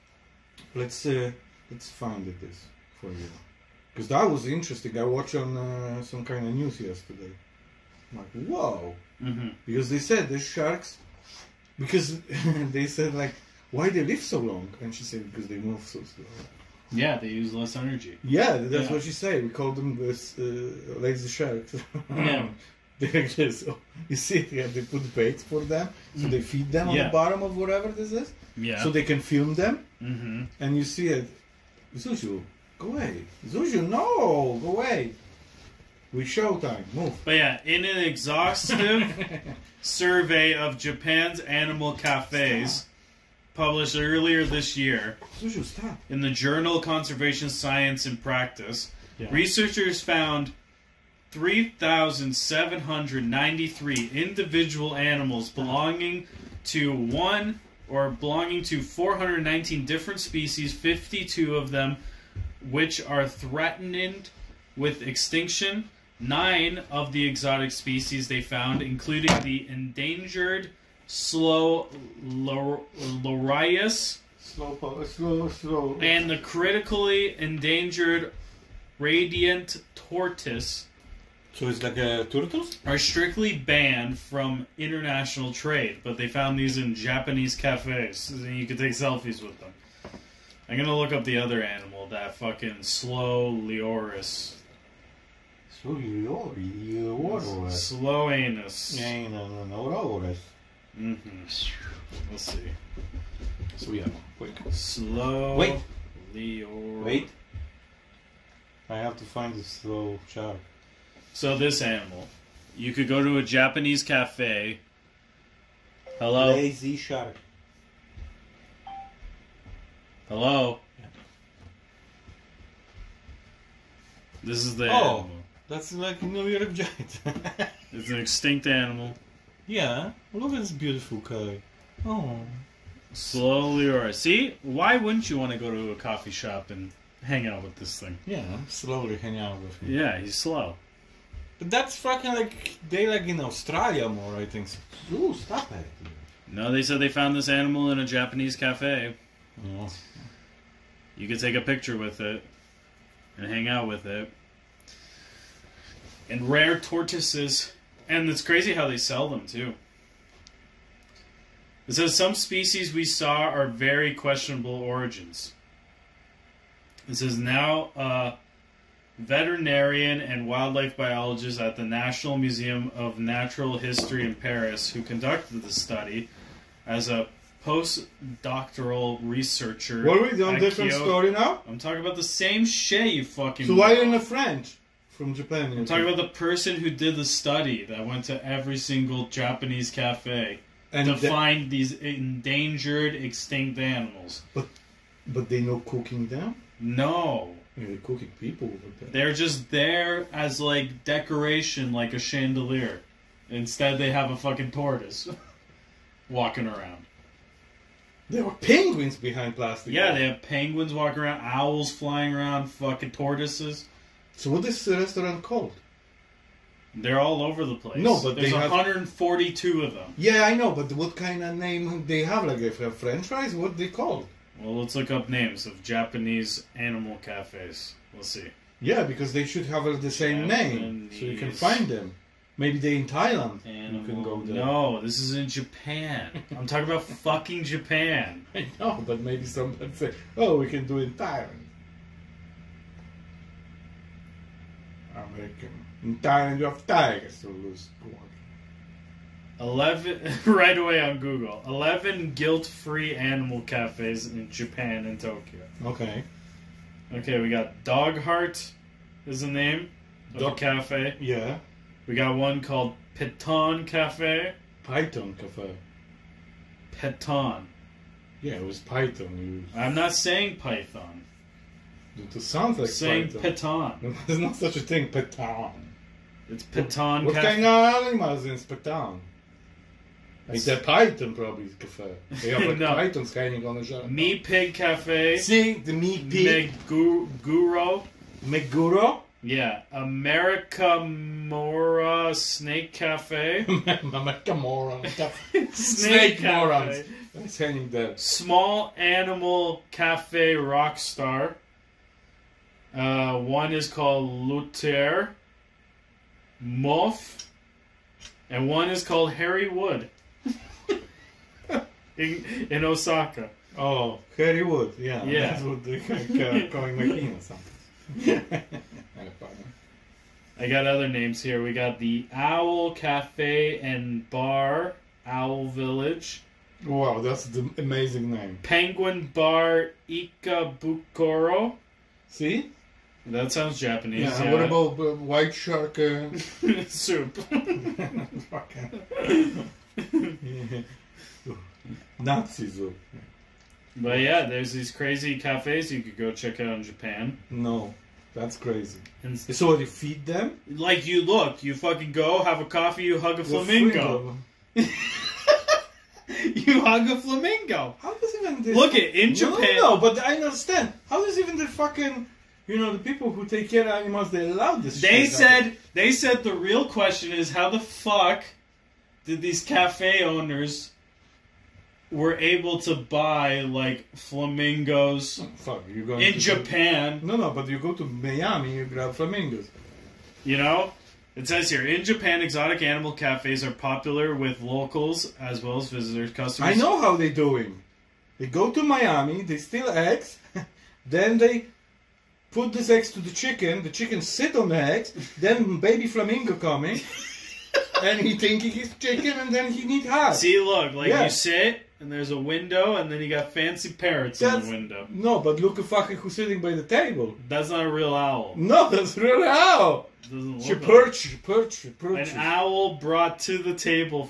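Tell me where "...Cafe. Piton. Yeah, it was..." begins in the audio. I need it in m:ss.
4:25.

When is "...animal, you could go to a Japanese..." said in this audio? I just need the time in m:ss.
1:51.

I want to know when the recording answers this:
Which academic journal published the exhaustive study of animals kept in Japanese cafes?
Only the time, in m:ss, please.
0:46.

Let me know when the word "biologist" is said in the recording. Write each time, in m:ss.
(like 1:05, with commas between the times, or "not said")
2:50.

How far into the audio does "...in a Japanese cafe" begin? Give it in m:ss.
2:27.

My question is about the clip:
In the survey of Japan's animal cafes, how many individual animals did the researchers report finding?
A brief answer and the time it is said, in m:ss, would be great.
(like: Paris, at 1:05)
3,793, at 0:51.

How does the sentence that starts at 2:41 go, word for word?
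It says some species we saw are very questionable origins.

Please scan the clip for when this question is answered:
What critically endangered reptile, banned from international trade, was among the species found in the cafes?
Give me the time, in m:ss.
1:18.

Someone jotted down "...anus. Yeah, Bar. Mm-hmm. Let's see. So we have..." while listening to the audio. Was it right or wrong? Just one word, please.
wrong.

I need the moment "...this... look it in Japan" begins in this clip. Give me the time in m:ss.
5:58.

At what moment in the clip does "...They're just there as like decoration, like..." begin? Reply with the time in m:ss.
3:19.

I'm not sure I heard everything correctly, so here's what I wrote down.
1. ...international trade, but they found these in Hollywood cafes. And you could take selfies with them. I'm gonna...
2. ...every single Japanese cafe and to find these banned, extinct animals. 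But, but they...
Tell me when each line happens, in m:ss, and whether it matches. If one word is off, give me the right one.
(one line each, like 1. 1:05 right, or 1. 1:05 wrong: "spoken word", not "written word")
1. 1:24 wrong: "Japanese", not "Hollywood"
2. 3:08 wrong: "endangered", not "banned".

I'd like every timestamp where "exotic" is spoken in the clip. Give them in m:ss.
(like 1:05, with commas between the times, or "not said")
1:07, 6:22.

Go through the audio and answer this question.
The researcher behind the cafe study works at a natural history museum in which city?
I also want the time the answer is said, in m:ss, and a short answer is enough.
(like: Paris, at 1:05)
Paris, at 2:54.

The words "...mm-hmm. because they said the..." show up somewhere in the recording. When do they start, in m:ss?
0:09.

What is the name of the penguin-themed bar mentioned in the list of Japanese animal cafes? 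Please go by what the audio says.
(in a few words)
Penguin Bar Ikebukuro.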